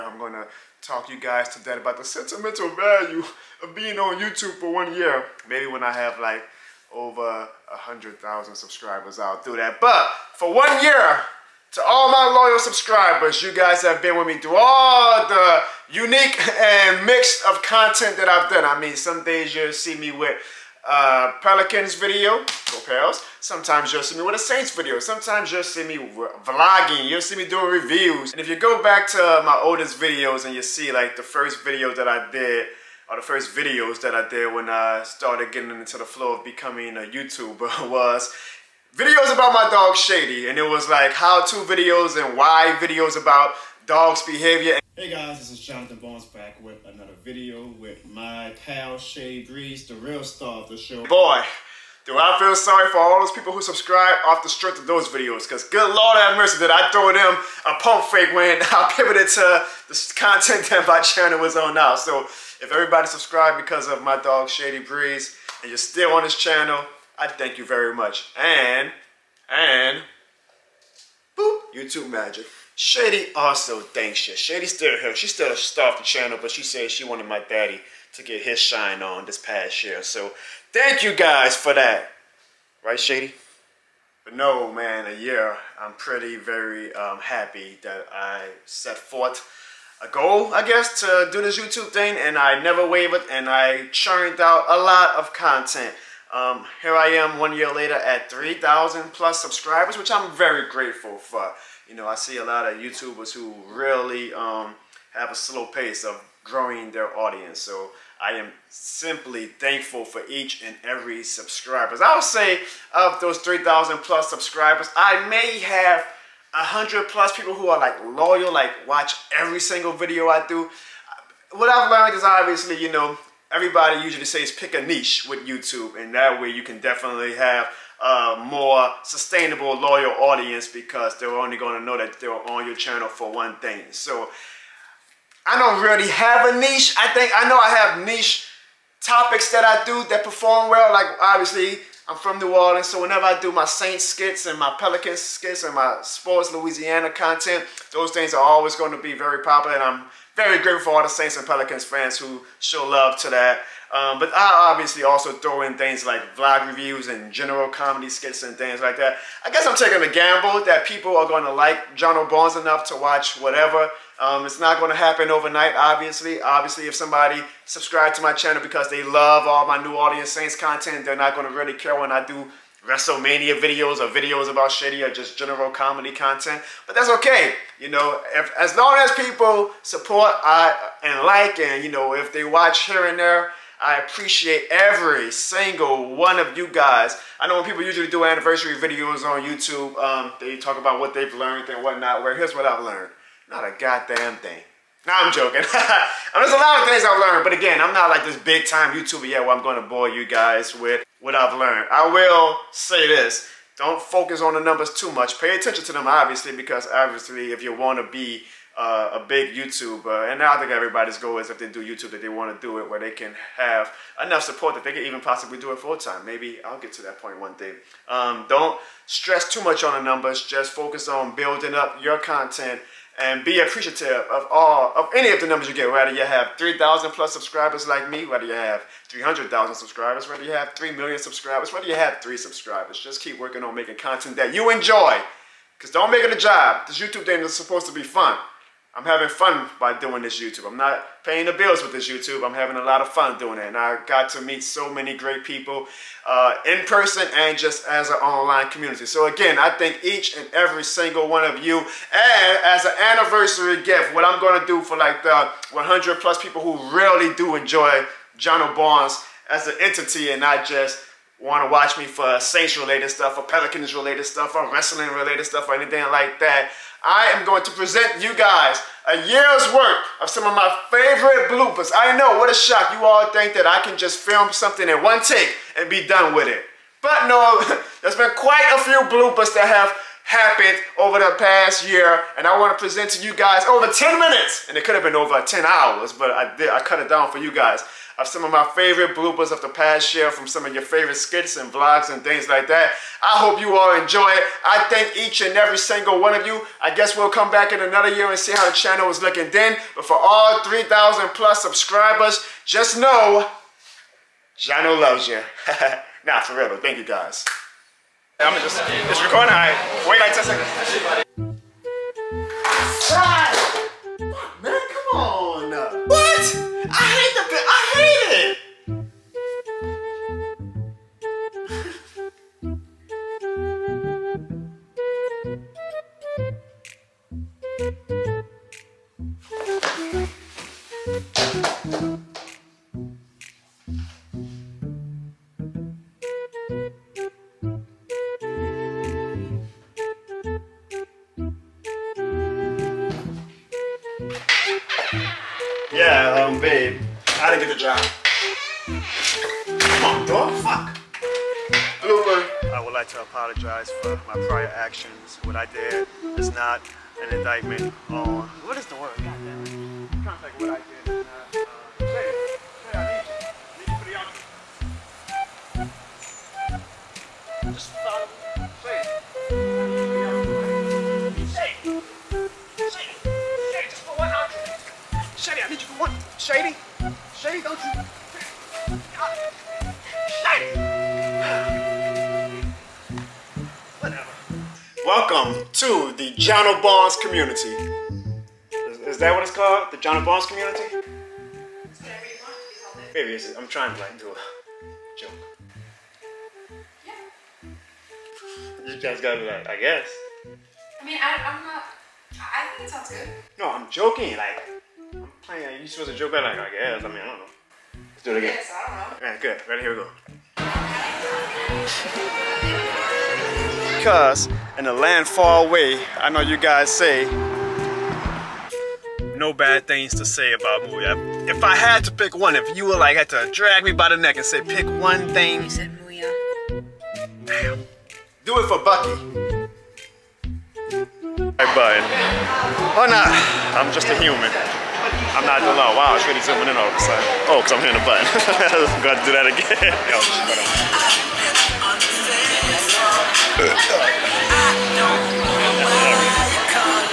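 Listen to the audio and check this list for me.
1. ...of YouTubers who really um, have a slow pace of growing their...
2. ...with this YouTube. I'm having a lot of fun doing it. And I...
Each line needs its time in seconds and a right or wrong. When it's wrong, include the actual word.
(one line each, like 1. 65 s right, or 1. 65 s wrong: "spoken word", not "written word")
1. 102 s right
2. 241 s right.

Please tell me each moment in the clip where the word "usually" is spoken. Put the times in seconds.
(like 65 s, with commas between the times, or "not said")
124 s, 187 s.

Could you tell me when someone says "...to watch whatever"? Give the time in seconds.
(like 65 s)
162 s.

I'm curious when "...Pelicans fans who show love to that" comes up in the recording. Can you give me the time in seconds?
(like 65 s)
151 s.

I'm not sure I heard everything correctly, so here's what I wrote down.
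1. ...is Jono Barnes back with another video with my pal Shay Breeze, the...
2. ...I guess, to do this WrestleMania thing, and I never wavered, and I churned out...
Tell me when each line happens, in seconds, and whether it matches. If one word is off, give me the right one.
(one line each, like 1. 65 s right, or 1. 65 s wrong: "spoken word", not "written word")
1. 45 s right
2. 90 s wrong: "YouTube", not "WrestleMania".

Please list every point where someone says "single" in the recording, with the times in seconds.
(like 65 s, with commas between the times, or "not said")
119 s, 185 s, 250 s, 295 s.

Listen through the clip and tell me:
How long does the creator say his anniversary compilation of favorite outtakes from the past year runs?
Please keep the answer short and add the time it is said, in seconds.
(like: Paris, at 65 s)
over 10 minutes, at 283 s.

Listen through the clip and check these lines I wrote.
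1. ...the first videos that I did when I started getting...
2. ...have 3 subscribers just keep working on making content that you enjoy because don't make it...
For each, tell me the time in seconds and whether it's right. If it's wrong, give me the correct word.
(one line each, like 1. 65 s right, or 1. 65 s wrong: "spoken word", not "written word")
1. 33 s right
2. 231 s right.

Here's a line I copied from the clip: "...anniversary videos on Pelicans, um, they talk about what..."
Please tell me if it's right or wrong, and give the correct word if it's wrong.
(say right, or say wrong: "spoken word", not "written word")
wrong: "YouTube", not "Pelicans".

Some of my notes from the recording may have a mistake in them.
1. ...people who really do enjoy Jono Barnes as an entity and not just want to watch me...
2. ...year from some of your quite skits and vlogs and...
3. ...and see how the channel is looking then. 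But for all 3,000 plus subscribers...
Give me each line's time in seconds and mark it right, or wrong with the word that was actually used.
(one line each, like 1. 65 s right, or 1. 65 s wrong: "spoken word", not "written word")
1. 256 s right
2. 290 s wrong: "favorite", not "quite"
3. 298 s right.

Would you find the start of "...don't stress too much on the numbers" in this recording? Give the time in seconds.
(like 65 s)
218 s.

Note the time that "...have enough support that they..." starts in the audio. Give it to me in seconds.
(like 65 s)
213 s.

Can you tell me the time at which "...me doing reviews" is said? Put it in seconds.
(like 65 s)
27 s.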